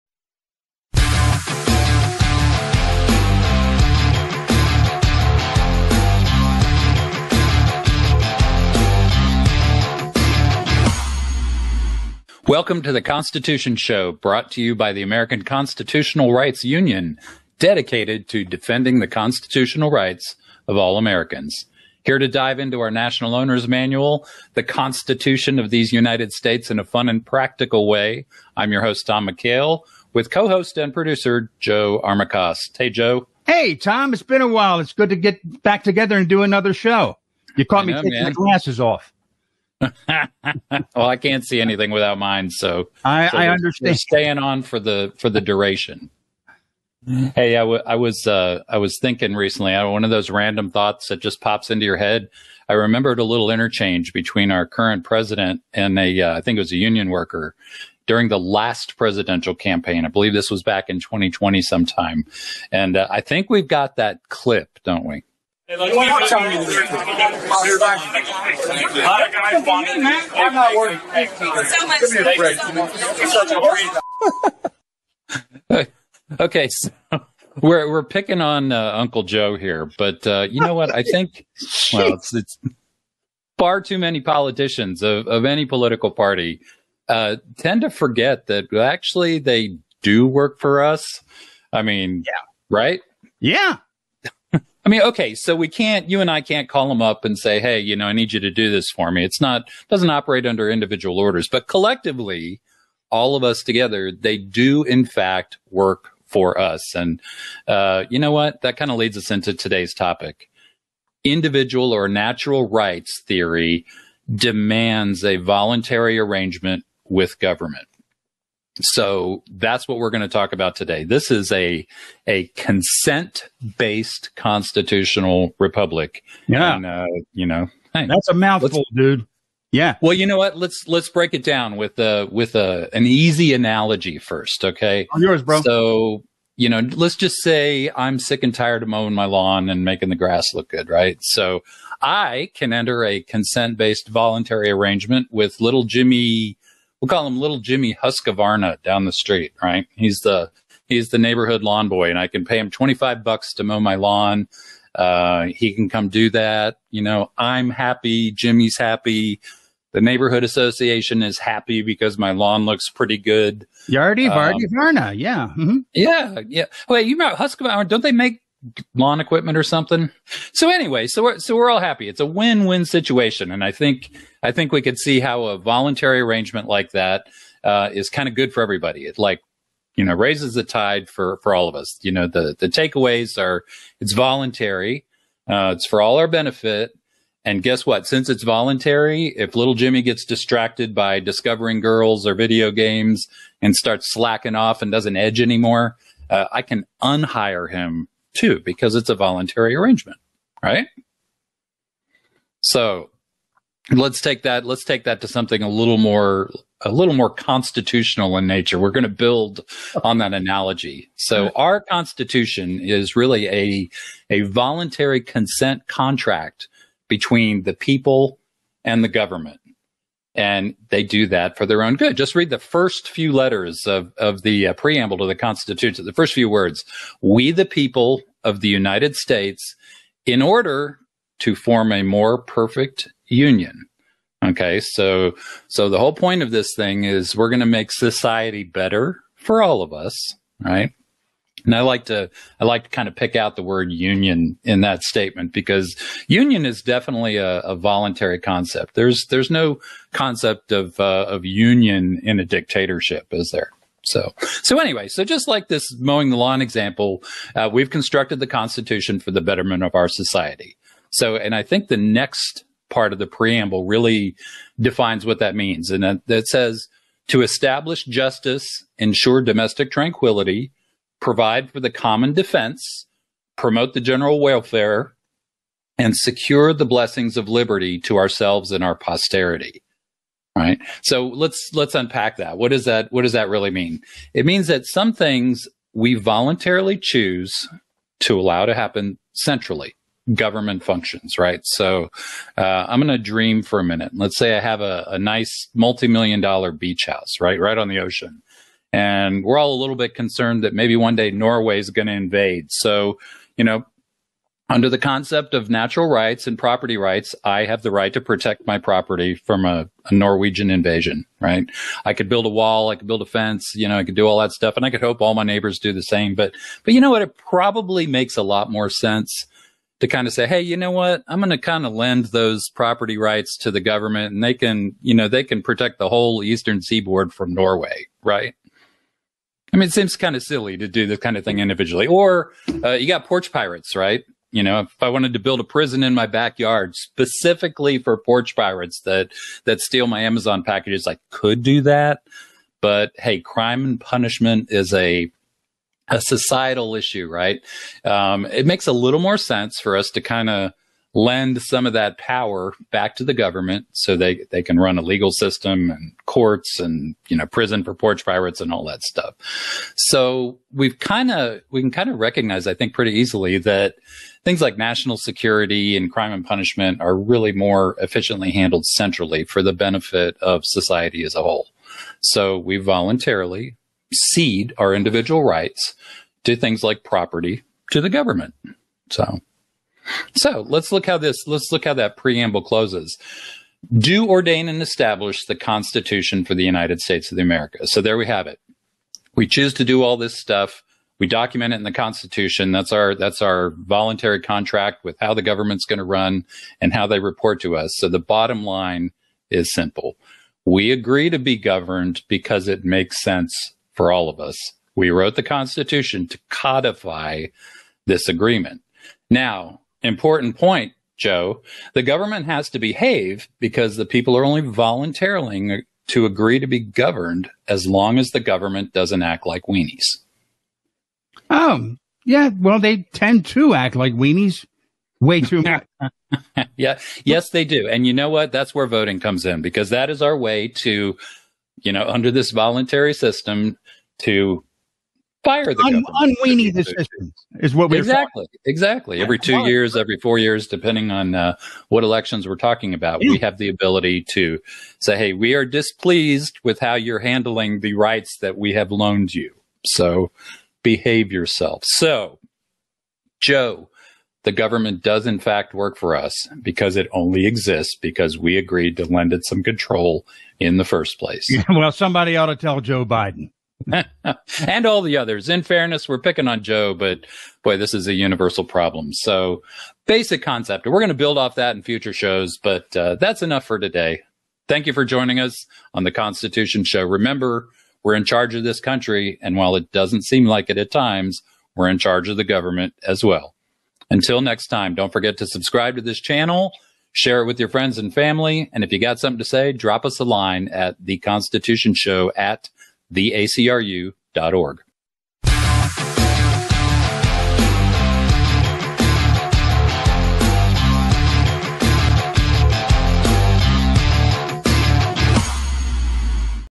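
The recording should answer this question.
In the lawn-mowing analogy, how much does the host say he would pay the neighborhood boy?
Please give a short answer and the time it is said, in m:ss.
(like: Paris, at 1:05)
$25, at 2:32.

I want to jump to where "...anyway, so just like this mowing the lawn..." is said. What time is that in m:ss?
4:14.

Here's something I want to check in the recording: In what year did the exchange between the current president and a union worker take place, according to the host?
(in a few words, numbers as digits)
2020.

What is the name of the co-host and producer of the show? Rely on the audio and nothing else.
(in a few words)
Joe Armacost.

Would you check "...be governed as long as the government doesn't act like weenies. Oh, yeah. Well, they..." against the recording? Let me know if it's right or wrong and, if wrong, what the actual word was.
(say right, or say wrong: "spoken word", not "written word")
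right.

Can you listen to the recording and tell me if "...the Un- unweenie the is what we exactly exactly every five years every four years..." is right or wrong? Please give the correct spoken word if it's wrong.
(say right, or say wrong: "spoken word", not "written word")
wrong: "two", not "five".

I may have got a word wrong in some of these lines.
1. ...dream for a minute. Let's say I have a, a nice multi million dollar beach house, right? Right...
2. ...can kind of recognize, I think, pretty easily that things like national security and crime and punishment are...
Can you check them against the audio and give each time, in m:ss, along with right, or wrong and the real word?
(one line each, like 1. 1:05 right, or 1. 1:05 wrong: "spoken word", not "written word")
1. 4:53 right
2. 6:01 right.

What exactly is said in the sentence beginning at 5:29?
I mean, it seems kind of silly to do this kind of thing individually.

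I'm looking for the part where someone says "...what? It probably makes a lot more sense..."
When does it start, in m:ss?
5:17.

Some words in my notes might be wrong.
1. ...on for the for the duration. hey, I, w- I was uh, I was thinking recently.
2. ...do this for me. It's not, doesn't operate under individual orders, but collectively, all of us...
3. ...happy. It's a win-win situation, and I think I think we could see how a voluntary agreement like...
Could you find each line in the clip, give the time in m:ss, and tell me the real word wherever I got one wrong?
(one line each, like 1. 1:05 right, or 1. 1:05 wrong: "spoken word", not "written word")
1. 0:44 right
2. 1:38 right
3. 2:51 wrong: "arrangement", not "agreement".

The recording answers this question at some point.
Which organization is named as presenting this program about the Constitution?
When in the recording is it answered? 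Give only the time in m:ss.
0:15.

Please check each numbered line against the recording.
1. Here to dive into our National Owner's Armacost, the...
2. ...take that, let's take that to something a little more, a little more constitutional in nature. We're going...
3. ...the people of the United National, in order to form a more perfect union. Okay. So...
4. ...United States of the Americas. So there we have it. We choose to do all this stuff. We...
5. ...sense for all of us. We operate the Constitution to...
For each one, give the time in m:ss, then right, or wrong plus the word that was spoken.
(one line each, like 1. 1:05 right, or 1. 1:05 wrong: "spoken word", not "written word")
1. 0:22 wrong: "Manual", not "Armacost"
2. 3:24 right
3. 3:47 wrong: "States", not "National"
4. 6:26 right
5. 6:43 wrong: "wrote", not "operate".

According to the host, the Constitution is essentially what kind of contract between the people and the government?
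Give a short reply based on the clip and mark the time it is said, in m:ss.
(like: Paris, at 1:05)
voluntary consent contract, at 3:34.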